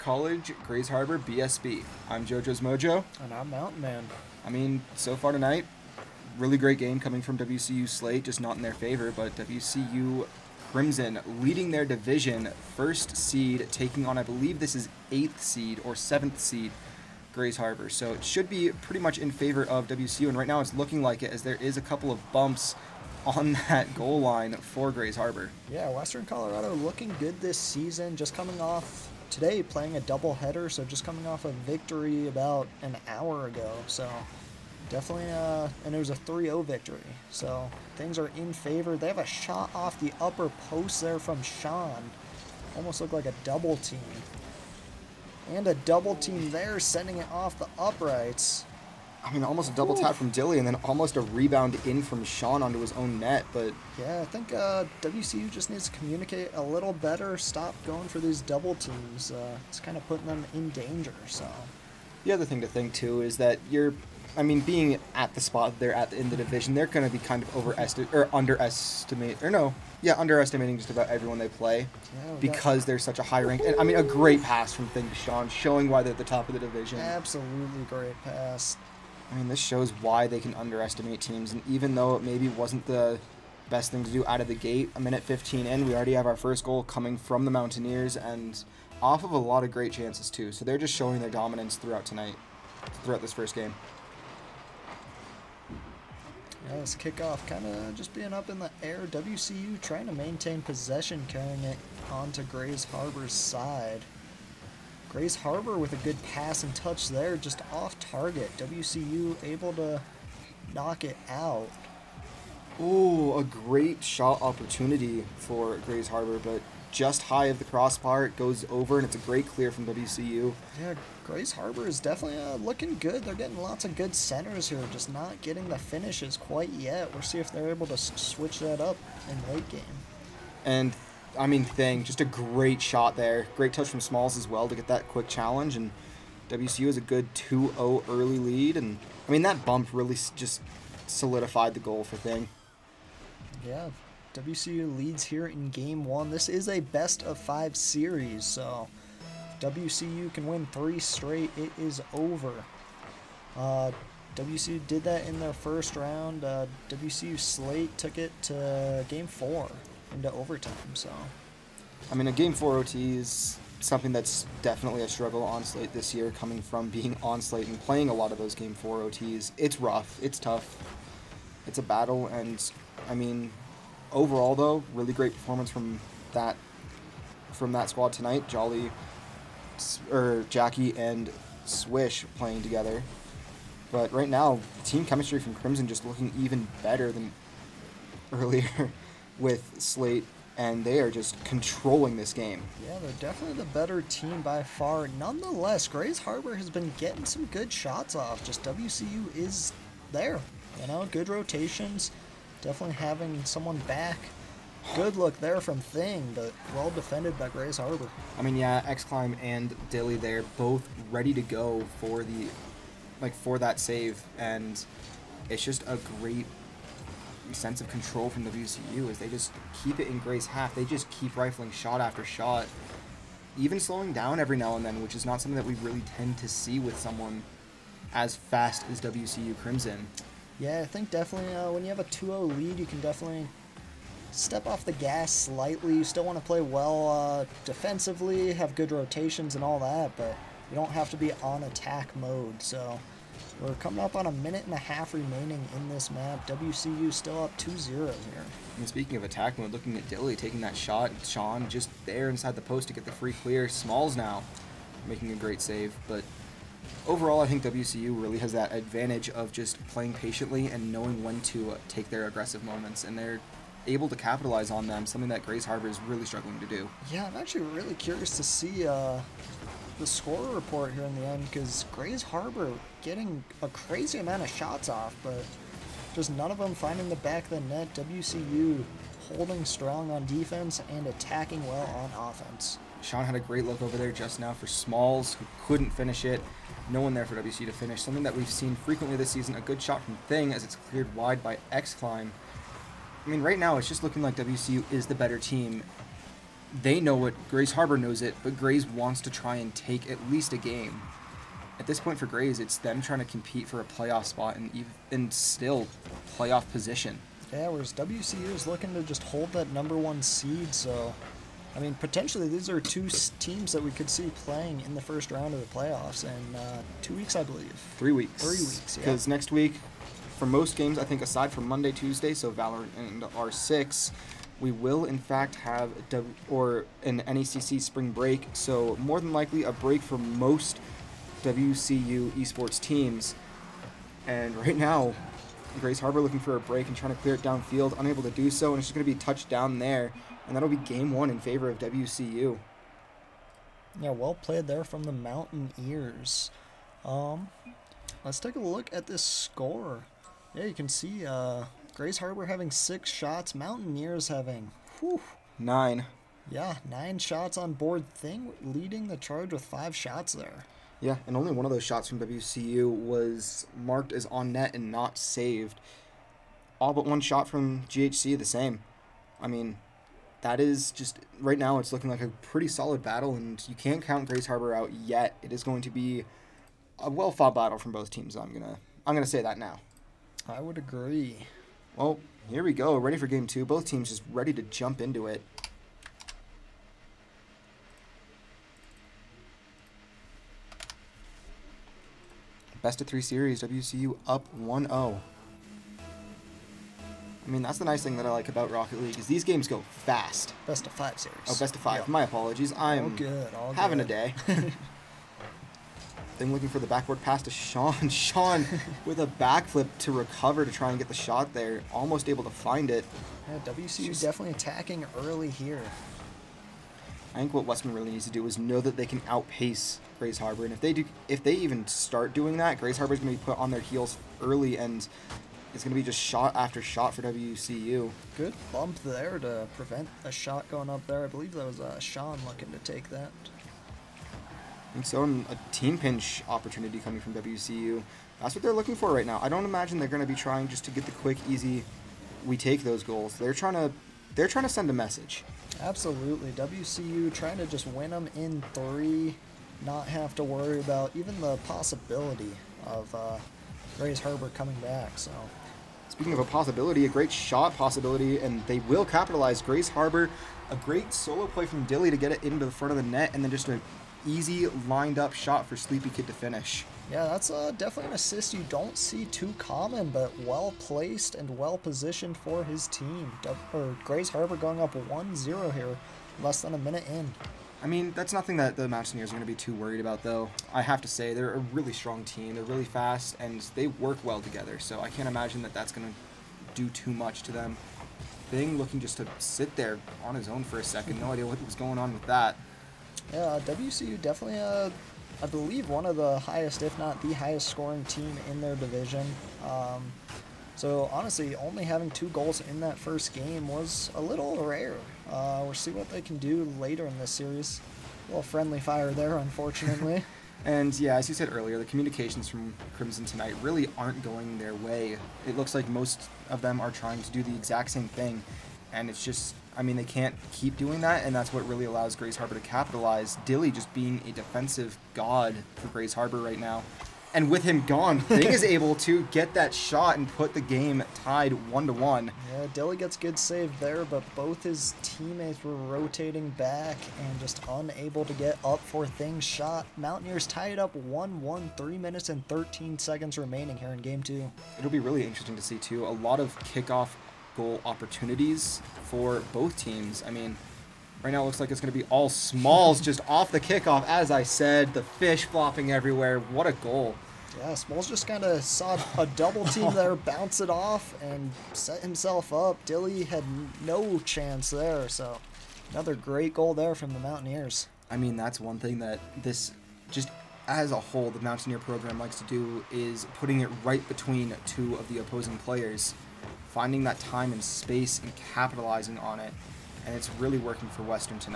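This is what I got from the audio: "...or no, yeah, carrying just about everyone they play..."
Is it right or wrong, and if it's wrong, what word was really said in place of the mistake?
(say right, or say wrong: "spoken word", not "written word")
wrong: "underestimating", not "carrying".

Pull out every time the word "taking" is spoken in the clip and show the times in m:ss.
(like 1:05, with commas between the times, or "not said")
0:13, 4:10.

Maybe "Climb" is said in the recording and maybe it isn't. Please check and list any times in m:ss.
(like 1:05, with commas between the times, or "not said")
3:29, 4:51.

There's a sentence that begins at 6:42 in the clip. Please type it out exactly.
I'm all good, all having good.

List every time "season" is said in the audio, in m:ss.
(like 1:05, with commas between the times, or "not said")
0:27, 4:49.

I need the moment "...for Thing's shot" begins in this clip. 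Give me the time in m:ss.
8:58.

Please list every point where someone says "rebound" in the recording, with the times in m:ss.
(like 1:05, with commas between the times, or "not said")
0:51.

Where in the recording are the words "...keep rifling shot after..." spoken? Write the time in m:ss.
3:41.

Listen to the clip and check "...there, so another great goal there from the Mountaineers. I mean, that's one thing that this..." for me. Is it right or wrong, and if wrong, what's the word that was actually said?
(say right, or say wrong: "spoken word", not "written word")
right.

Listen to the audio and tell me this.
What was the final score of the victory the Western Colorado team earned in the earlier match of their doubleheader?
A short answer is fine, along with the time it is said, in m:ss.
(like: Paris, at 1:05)
3-0, at 0:36.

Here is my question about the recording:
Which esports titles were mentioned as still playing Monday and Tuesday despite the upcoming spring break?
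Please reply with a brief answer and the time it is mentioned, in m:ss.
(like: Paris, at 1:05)
Valorant and R6, at 5:22.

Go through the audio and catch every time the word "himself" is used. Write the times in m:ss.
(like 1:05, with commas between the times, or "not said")
9:21.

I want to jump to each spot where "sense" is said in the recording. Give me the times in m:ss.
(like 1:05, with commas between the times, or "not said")
3:37.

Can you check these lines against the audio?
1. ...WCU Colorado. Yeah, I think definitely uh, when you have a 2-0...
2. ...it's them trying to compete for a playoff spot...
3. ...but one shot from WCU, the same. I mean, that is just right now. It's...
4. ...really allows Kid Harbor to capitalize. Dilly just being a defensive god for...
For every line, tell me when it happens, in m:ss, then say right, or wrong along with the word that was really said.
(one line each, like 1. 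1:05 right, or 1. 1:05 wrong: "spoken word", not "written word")
1. 3:49 wrong: "Crimson", not "Colorado"
2. 5:02 right
3. 6:06 wrong: "GHC", not "WCU"
4. 8:41 wrong: "Grays", not "Kid".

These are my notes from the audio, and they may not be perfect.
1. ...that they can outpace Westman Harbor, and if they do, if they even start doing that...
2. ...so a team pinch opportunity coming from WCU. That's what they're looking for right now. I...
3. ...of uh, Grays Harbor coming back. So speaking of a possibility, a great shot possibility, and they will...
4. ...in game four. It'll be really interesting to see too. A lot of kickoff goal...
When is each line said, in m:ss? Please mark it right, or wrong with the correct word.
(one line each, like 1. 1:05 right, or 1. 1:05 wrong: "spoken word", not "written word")
1. 6:58 wrong: "Grays", not "Westman"
2. 7:15 right
3. 7:32 right
4. 9:03 wrong: "two", not "four".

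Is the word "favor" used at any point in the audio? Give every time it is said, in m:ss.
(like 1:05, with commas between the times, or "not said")
0:08, 0:19, 0:38, 5:41.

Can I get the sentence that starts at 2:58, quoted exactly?
Jolly, or Jackie and Swish playing together.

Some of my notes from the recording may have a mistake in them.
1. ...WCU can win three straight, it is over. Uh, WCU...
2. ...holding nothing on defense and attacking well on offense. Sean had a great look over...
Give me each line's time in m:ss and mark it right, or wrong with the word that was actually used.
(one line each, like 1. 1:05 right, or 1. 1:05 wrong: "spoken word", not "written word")
1. 2:29 right
2. 4:39 wrong: "strong", not "nothing".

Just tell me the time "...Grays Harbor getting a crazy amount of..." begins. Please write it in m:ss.
4:31.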